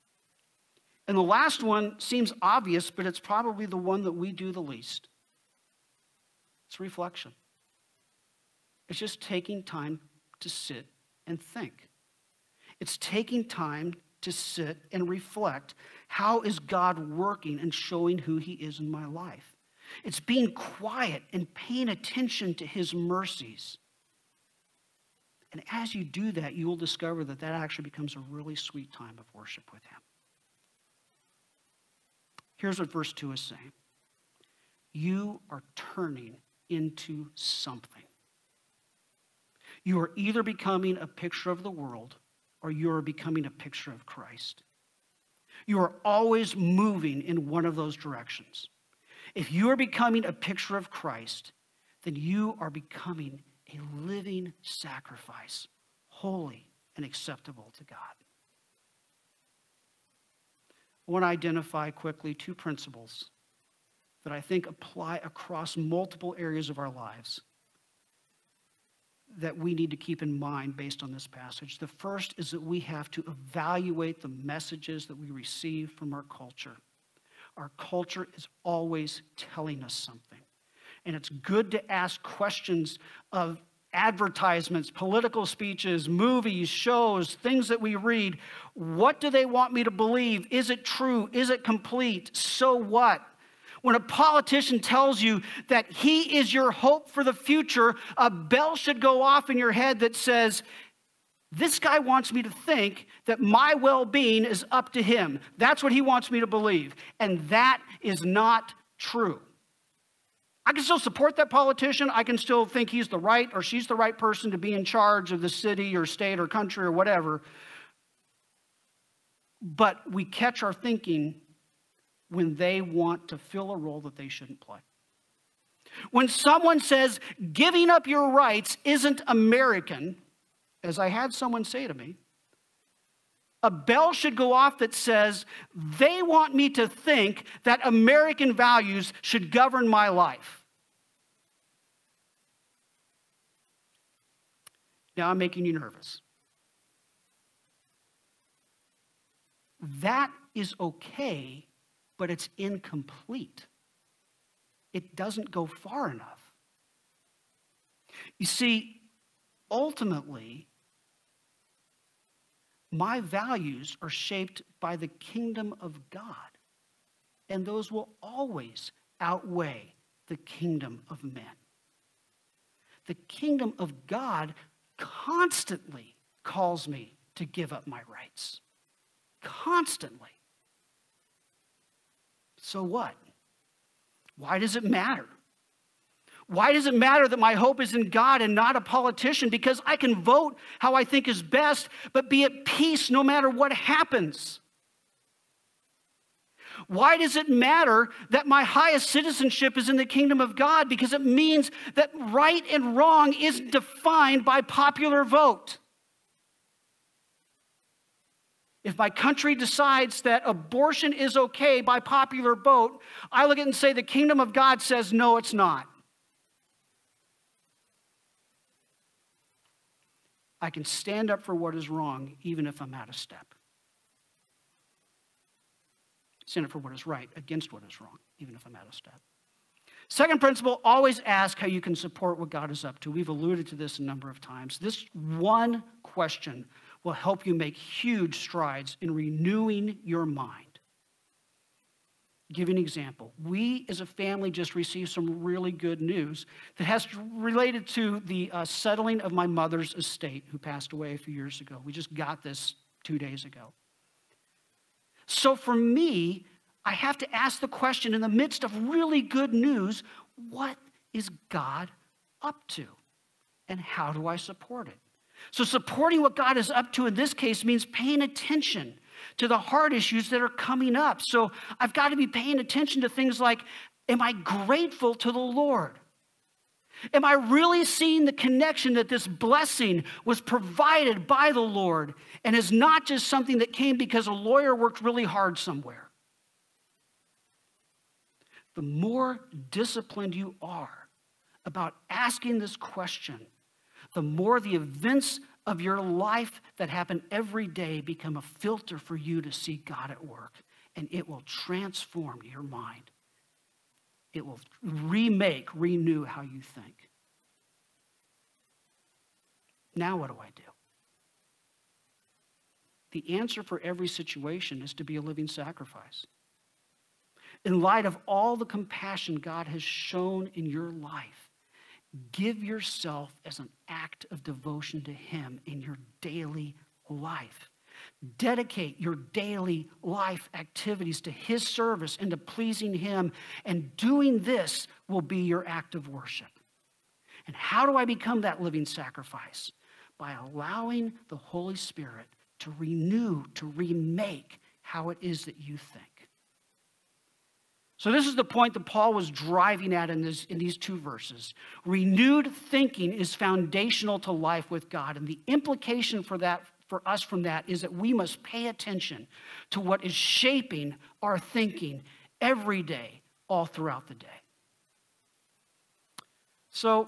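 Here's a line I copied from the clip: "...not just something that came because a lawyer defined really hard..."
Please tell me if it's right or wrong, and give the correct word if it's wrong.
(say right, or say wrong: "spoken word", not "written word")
wrong: "worked", not "defined".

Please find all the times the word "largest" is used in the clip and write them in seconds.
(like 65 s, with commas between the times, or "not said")
not said.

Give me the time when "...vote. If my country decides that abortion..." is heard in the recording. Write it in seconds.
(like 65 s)
205 s.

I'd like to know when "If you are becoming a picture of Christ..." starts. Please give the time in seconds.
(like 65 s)
49 s.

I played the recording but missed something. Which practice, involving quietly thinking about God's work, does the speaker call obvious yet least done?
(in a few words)
Reflection.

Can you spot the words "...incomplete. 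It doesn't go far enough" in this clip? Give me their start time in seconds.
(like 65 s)
152 s.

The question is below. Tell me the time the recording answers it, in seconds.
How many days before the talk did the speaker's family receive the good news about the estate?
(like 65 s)
253 s.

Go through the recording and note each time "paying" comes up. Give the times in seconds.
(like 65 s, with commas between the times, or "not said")
21 s, 267 s, 272 s.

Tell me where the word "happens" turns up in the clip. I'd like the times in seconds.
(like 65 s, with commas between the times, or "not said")
193 s, 296 s.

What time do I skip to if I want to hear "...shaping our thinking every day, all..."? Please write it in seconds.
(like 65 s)
360 s.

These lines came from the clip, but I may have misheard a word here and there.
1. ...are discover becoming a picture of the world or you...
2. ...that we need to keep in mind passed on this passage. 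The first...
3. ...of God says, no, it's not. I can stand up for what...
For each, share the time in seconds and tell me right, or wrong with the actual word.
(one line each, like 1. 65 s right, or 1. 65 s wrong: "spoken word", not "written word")
1. 40 s wrong: "either", not "discover"
2. 69 s wrong: "based", not "passed"
3. 214 s right.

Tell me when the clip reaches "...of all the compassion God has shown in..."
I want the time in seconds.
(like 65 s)
318 s.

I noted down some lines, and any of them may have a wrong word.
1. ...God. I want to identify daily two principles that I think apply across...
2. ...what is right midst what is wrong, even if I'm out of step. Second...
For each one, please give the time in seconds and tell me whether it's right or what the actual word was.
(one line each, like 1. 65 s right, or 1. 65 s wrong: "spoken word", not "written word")
1. 57 s wrong: "quickly", not "daily"
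2. 226 s wrong: "against", not "midst".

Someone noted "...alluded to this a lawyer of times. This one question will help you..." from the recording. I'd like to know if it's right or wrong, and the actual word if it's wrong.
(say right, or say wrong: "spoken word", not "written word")
wrong: "number", not "lawyer".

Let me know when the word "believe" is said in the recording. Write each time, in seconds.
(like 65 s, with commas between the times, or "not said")
89 s, 106 s.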